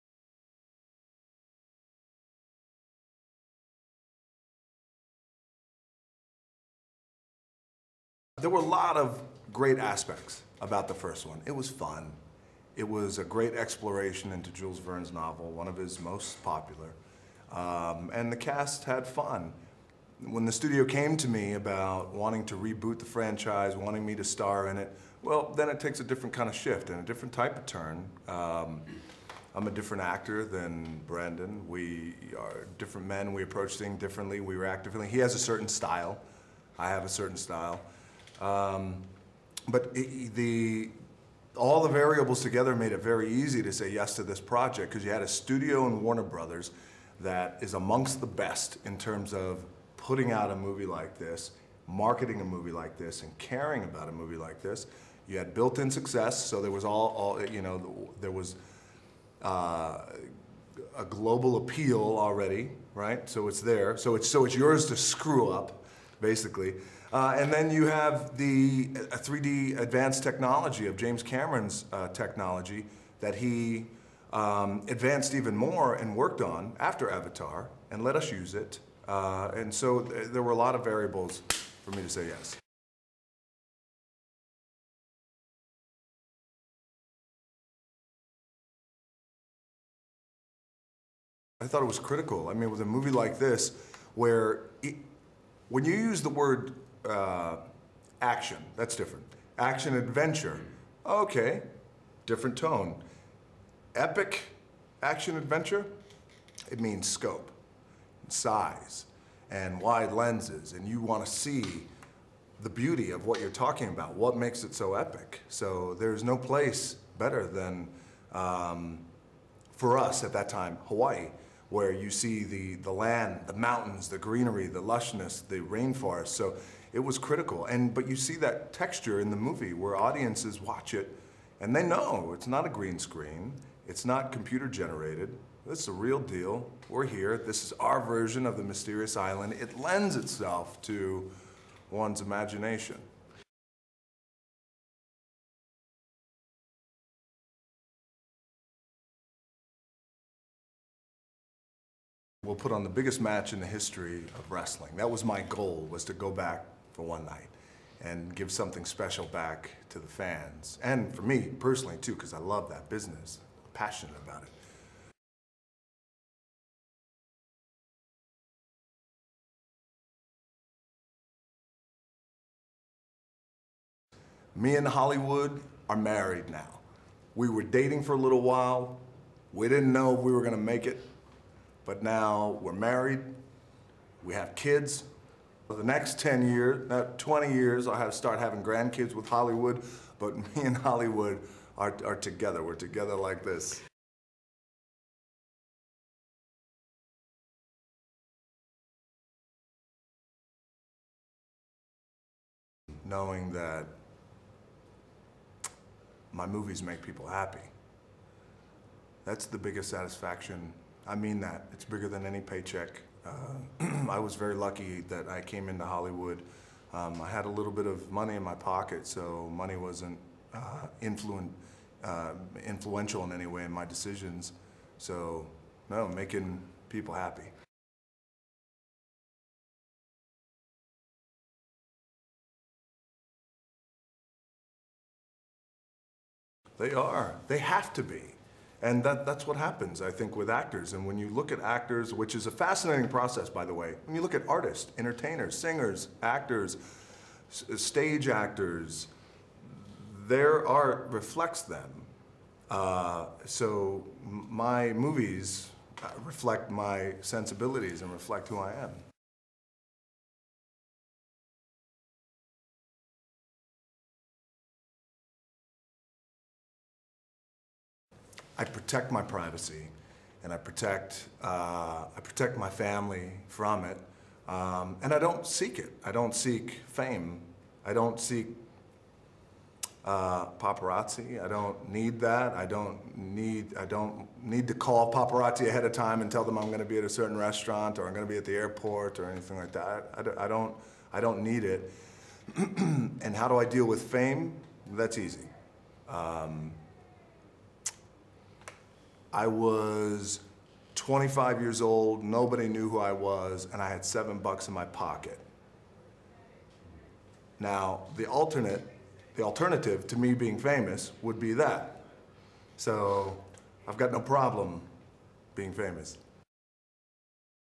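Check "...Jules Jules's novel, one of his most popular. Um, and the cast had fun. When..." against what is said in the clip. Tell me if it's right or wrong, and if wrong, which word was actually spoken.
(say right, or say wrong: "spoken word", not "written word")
wrong: "Verne", not "Jules".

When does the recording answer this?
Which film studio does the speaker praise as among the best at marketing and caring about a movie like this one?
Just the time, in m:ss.
0:46.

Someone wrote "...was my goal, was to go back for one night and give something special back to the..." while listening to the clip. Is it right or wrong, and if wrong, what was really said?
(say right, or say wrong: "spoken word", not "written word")
right.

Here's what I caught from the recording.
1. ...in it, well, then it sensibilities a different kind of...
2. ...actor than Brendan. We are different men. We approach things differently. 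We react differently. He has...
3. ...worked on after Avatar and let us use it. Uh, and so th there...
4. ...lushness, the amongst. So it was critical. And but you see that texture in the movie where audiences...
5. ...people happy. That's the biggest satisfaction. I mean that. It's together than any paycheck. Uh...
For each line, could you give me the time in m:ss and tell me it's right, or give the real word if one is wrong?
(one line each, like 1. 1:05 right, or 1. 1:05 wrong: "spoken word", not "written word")
1. 0:24 wrong: "takes", not "sensibilities"
2. 0:30 right
3. 1:16 right
4. 2:04 wrong: "rainforest", not "amongst"
5. 3:27 wrong: "bigger", not "together".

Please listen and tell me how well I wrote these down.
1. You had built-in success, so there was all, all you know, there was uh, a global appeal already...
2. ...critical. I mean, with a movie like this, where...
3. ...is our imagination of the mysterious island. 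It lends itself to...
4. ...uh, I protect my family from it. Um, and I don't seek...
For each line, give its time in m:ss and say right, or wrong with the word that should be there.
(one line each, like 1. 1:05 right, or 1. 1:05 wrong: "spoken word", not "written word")
1. 0:55 right
2. 1:31 right
3. 2:17 wrong: "version", not "imagination"
4. 4:31 right.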